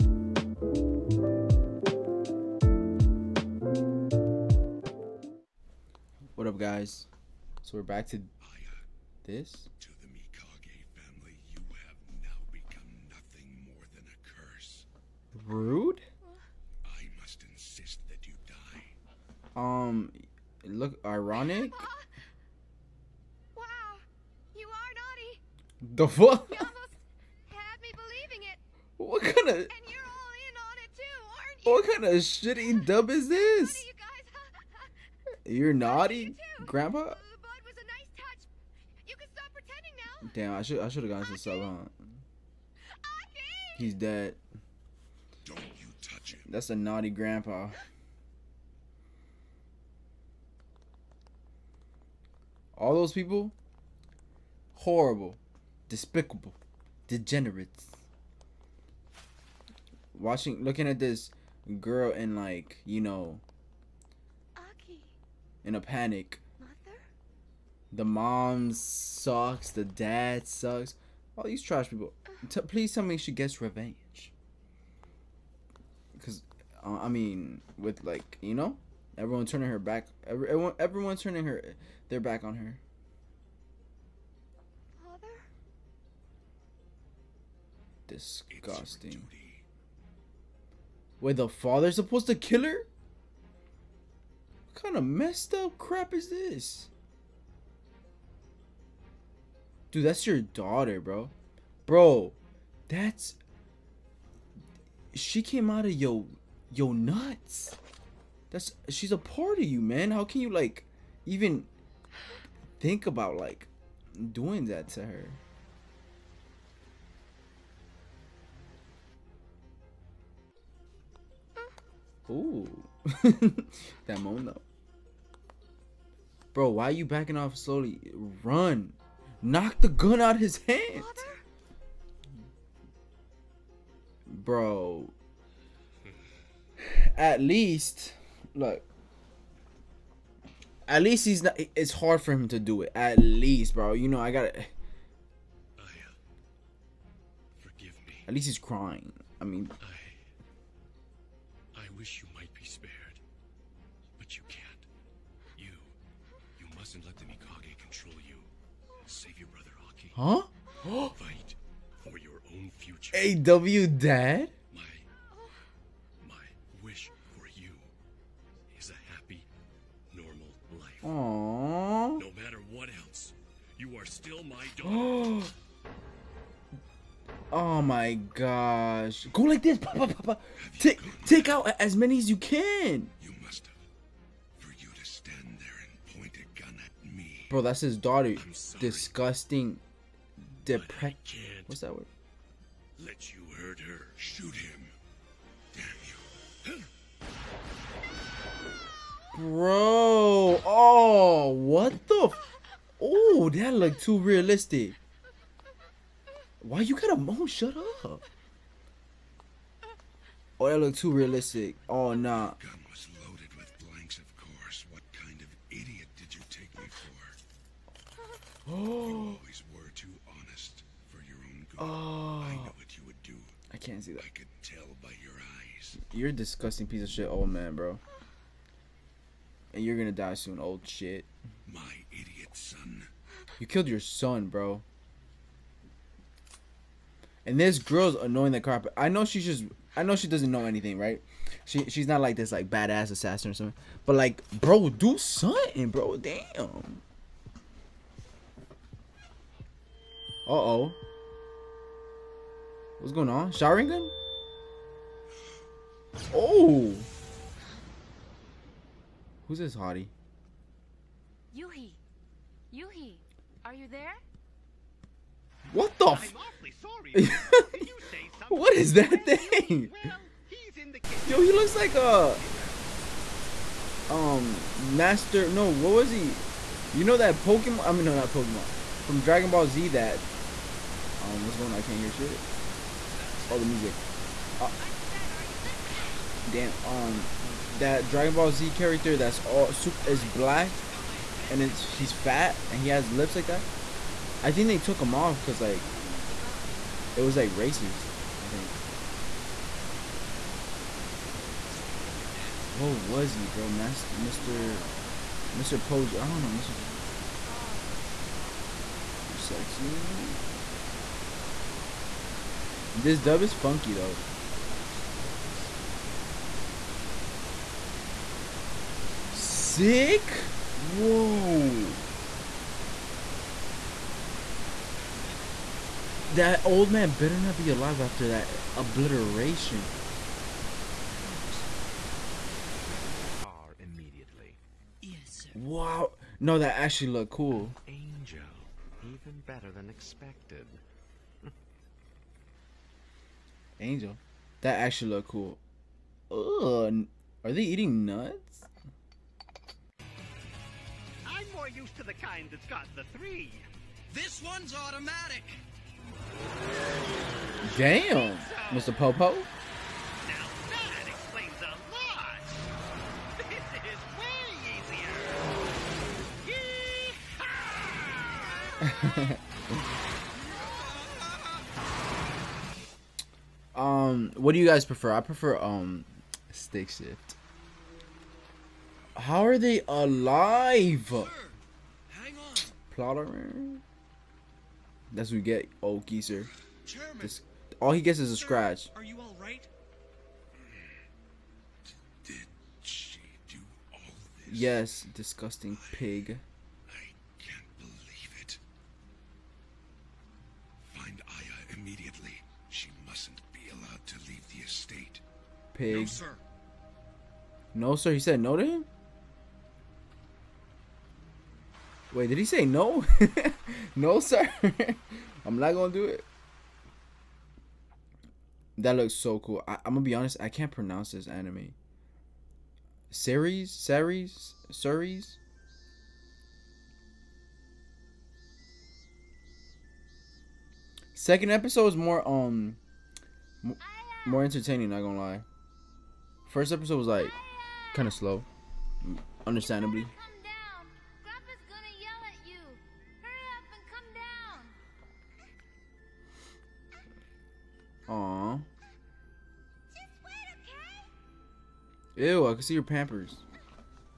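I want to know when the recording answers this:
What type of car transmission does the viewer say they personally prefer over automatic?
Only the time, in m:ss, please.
6:16.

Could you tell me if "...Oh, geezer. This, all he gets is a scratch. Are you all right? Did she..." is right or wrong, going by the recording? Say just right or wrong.
right.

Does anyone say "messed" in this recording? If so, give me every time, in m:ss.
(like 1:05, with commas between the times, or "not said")
1:35.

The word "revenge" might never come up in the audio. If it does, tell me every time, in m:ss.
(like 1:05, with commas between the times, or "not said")
1:13.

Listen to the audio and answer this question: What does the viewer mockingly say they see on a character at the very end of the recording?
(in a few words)
Pampers.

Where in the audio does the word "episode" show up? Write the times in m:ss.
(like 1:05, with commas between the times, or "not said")
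7:11, 7:16.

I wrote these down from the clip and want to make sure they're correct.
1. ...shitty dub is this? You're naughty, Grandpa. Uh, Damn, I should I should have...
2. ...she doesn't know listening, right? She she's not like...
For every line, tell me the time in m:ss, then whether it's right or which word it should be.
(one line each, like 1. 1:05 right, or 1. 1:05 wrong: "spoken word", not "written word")
1. 0:32 right
2. 4:00 wrong: "anything", not "listening".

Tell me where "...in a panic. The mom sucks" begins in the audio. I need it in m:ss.
1:05.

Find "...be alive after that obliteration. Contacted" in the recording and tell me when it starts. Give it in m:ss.
5:27.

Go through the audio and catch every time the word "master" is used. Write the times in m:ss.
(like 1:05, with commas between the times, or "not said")
4:34.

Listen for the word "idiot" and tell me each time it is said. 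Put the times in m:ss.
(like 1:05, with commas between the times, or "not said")
3:35, 3:52.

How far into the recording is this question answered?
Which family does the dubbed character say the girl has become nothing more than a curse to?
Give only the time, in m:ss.
0:10.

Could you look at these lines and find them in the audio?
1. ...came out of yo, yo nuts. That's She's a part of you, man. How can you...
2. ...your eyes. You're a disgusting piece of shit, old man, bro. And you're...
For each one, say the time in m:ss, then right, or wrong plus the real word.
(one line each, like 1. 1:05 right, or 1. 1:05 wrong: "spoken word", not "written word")
1. 1:45 right
2. 3:45 right.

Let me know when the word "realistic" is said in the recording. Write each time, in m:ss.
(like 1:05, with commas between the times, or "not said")
3:24, 3:31.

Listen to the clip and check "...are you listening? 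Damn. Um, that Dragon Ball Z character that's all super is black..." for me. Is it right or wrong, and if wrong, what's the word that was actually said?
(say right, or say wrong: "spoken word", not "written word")
right.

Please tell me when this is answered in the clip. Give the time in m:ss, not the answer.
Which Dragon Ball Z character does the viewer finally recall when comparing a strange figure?
5:58.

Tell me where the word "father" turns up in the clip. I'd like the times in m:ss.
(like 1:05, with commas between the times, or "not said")
1:25, 1:31.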